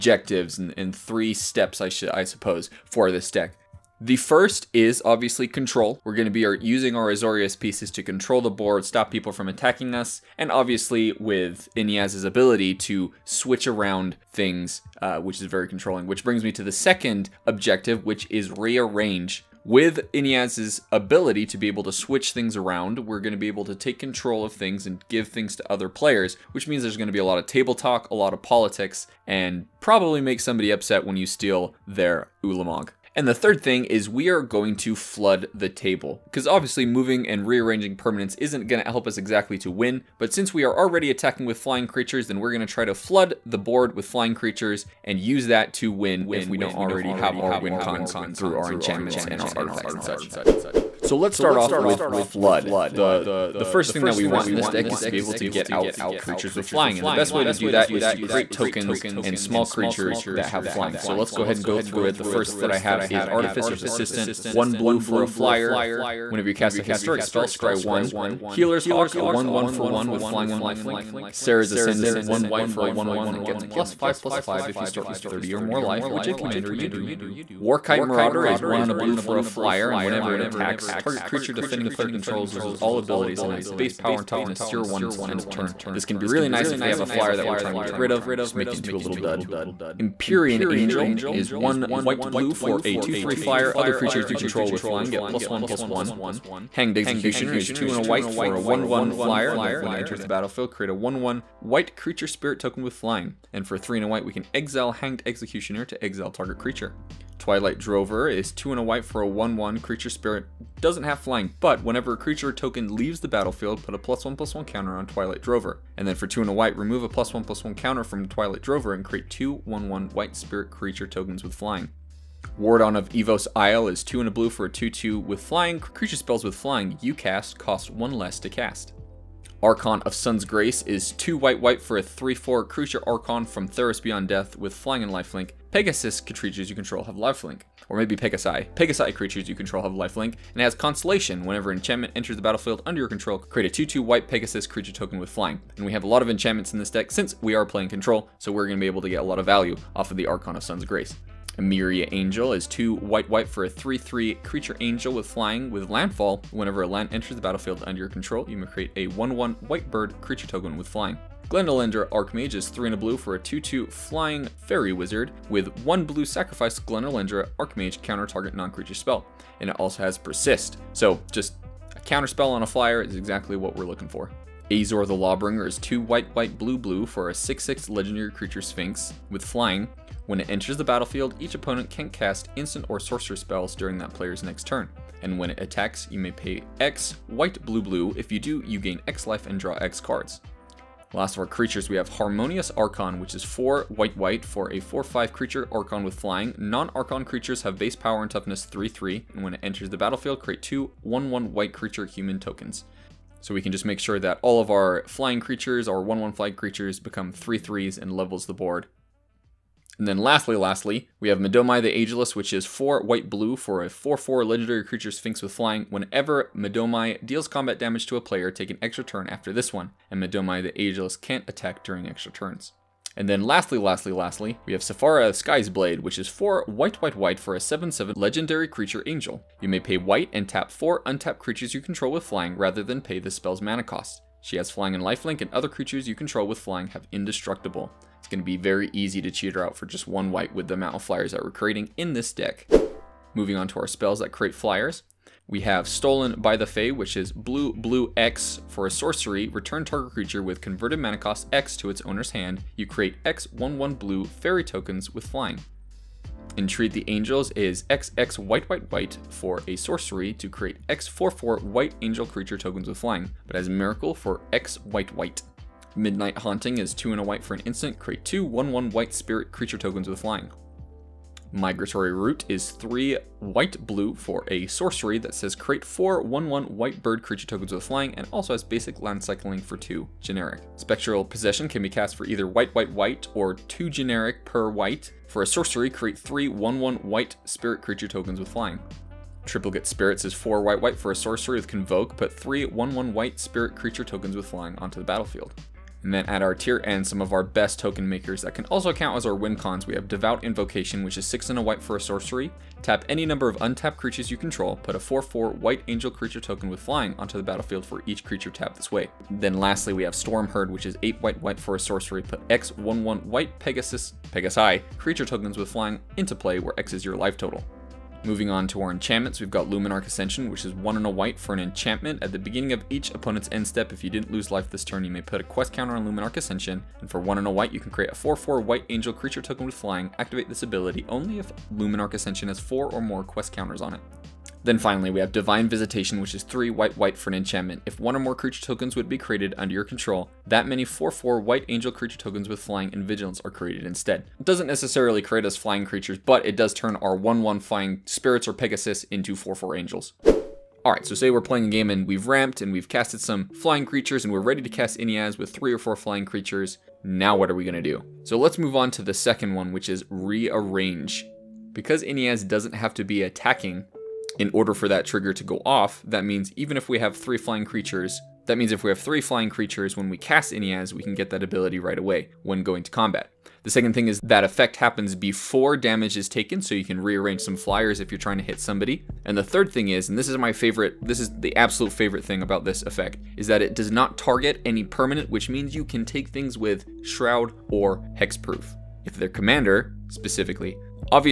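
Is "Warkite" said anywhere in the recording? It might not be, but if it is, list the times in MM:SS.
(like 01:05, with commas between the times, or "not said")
01:17.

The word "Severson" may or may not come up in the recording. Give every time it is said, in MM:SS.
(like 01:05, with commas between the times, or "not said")
not said.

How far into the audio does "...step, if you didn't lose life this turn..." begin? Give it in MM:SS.
05:23.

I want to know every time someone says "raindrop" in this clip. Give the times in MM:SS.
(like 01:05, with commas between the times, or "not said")
not said.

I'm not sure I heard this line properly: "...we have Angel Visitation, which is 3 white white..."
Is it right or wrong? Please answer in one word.
wrong.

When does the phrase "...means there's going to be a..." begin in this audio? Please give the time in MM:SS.
00:26.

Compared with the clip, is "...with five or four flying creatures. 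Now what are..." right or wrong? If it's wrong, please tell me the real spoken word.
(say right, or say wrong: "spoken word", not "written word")
wrong: "three", not "five".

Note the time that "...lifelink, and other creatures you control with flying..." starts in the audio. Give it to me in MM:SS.
03:55.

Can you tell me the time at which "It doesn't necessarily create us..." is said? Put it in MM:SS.
05:44.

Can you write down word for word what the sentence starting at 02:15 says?
Pegasus creatures you control have lifelink.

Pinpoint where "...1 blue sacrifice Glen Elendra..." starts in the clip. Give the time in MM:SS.
02:45.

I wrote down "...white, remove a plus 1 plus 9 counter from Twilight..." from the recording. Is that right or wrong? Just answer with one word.
wrong.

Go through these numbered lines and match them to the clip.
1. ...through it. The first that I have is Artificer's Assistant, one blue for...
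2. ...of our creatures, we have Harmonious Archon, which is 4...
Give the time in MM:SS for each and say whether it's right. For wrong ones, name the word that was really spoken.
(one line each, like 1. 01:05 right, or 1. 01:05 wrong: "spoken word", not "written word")
1. 01:01 right
2. 03:11 right.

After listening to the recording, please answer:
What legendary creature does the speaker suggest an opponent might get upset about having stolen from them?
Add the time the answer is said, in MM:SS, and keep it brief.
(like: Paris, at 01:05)
Ulamog, at 00:32.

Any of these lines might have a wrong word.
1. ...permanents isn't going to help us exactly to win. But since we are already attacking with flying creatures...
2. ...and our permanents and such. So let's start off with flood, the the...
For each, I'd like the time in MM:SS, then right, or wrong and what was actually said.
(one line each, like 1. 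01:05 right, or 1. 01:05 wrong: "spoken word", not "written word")
1. 00:37 right
2. 00:49 wrong: "artifacts", not "permanents".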